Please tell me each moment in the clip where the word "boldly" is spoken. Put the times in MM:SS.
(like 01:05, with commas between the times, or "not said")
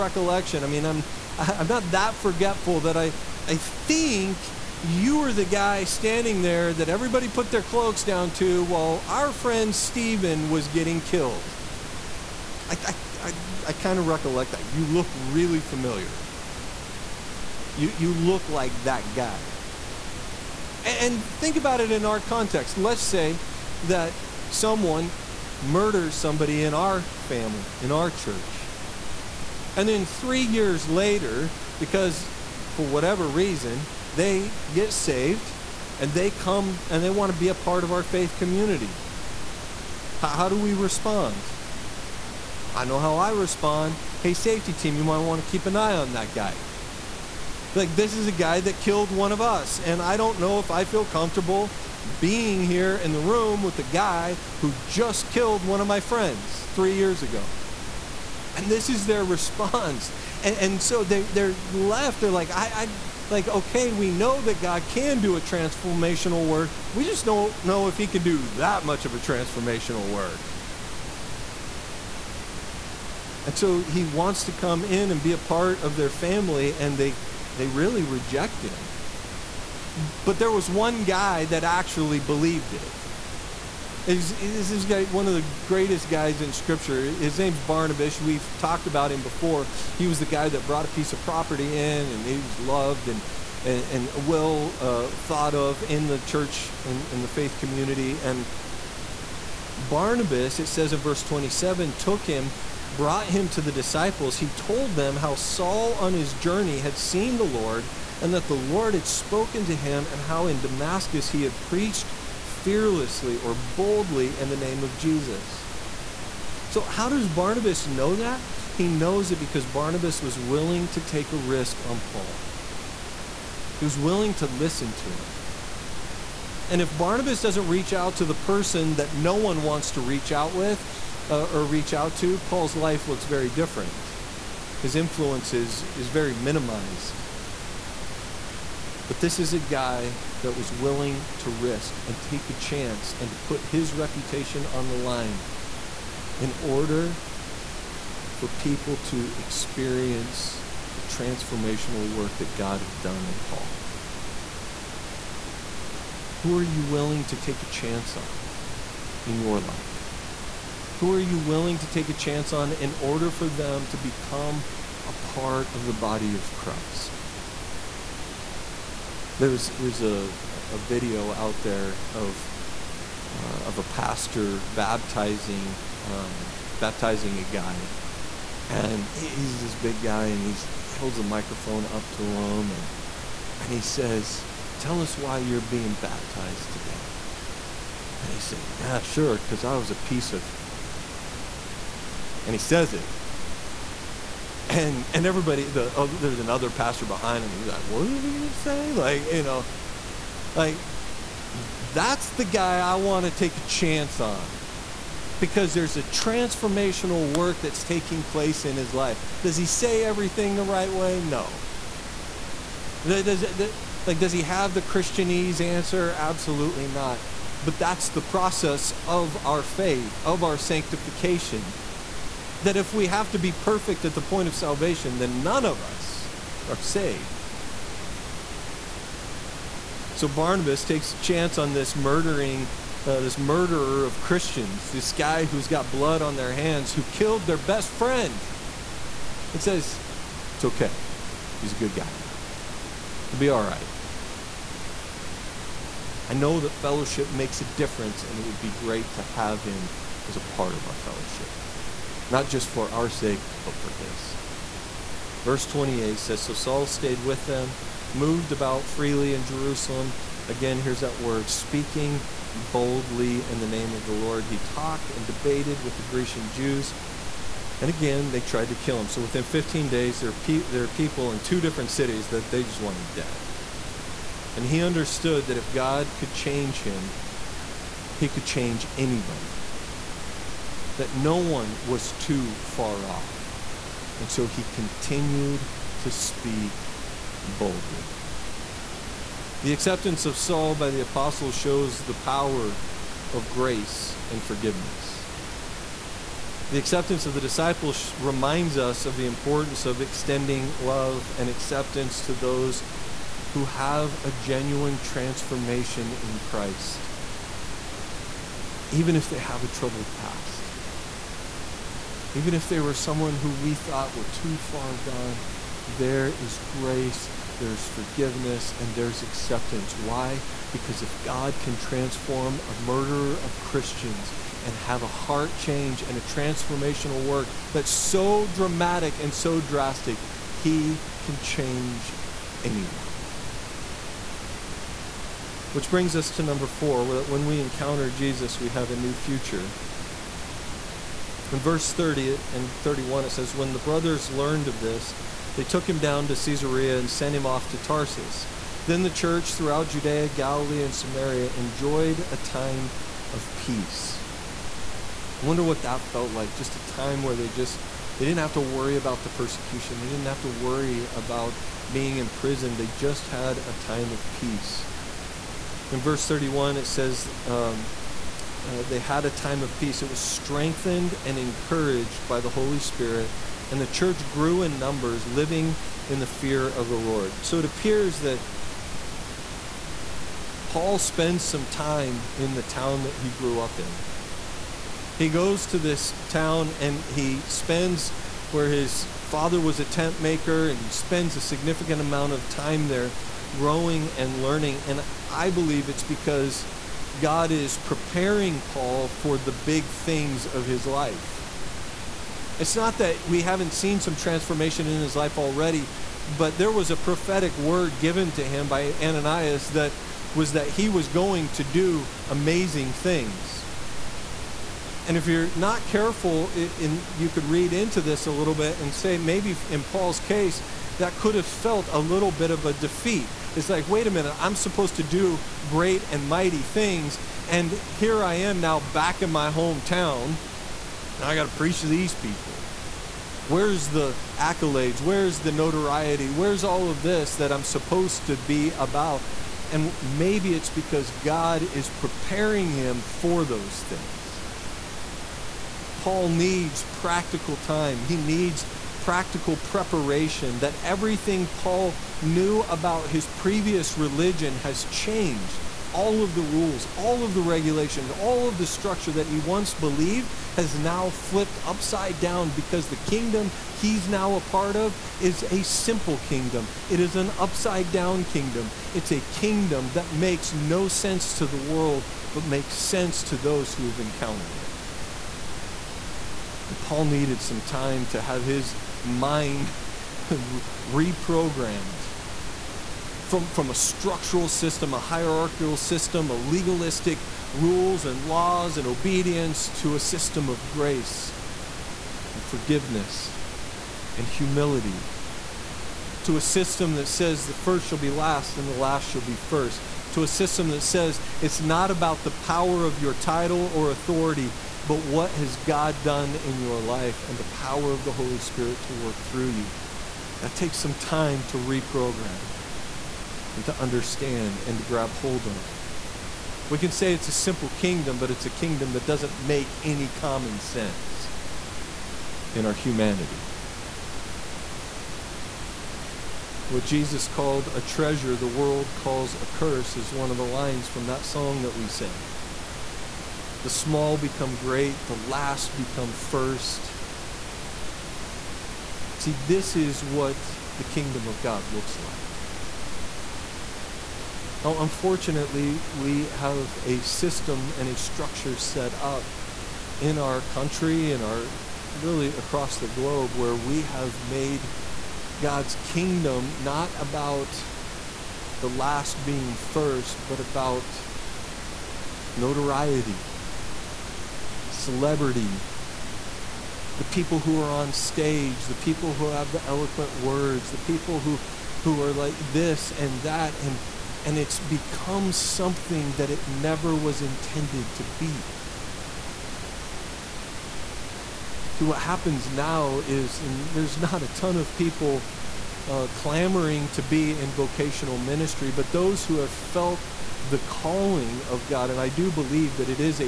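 01:53, 04:22, 04:47.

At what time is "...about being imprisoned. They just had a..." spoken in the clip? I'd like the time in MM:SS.
06:01.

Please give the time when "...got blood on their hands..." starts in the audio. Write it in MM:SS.
03:55.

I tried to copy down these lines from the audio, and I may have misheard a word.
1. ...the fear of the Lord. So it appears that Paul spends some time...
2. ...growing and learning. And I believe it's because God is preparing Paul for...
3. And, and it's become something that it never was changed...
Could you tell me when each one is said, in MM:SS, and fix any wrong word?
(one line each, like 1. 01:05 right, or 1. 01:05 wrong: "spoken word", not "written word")
1. 06:16 right
2. 06:33 right
3. 09:33 wrong: "intended", not "changed".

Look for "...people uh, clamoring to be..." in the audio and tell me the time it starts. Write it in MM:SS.
09:44.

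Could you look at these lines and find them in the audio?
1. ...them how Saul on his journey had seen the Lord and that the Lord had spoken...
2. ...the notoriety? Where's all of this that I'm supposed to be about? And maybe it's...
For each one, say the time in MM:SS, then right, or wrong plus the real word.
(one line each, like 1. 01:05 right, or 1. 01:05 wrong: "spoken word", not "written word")
1. 01:44 right
2. 07:15 right.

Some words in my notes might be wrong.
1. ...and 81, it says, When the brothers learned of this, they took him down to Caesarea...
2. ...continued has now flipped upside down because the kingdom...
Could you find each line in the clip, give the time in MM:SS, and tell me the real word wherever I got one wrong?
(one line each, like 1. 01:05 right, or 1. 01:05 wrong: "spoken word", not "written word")
1. 05:42 wrong: "31", not "81"
2. 07:39 wrong: "believed", not "continued".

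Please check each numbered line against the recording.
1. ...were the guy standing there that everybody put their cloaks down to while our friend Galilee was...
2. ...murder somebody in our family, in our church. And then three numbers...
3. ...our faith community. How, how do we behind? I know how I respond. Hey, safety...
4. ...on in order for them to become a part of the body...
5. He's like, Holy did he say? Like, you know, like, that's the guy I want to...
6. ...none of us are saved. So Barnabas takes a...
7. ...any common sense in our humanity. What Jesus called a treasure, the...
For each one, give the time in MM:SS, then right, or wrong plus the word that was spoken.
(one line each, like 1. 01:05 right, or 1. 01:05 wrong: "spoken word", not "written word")
1. 00:05 wrong: "Stephen", not "Galilee"
2. 00:25 wrong: "years", not "numbers"
3. 00:37 wrong: "respond", not "behind"
4. 02:42 right
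5. 03:17 wrong: "What", not "Holy"
6. 03:45 right
7. 08:39 right.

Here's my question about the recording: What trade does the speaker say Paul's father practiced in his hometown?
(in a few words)
Tent maker.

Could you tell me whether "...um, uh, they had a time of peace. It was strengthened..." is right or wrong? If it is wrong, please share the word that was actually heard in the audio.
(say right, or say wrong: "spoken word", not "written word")
right.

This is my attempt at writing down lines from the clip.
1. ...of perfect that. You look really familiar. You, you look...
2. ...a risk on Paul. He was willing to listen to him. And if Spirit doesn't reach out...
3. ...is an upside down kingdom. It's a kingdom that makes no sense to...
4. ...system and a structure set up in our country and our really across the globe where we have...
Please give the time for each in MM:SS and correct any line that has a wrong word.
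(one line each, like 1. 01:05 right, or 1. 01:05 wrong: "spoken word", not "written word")
1. 00:13 wrong: "recollect", not "perfect"
2. 02:01 wrong: "Barnabas", not "Spirit"
3. 07:46 right
4. 09:06 right.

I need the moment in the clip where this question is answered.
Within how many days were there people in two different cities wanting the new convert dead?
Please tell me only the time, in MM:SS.
04:29.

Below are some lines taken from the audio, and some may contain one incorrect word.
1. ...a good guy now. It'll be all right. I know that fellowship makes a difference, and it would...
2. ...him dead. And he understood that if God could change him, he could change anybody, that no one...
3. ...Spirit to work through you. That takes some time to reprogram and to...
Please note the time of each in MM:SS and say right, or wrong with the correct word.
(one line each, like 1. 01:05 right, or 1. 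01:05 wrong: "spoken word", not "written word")
1. 04:01 right
2. 04:32 right
3. 08:28 right.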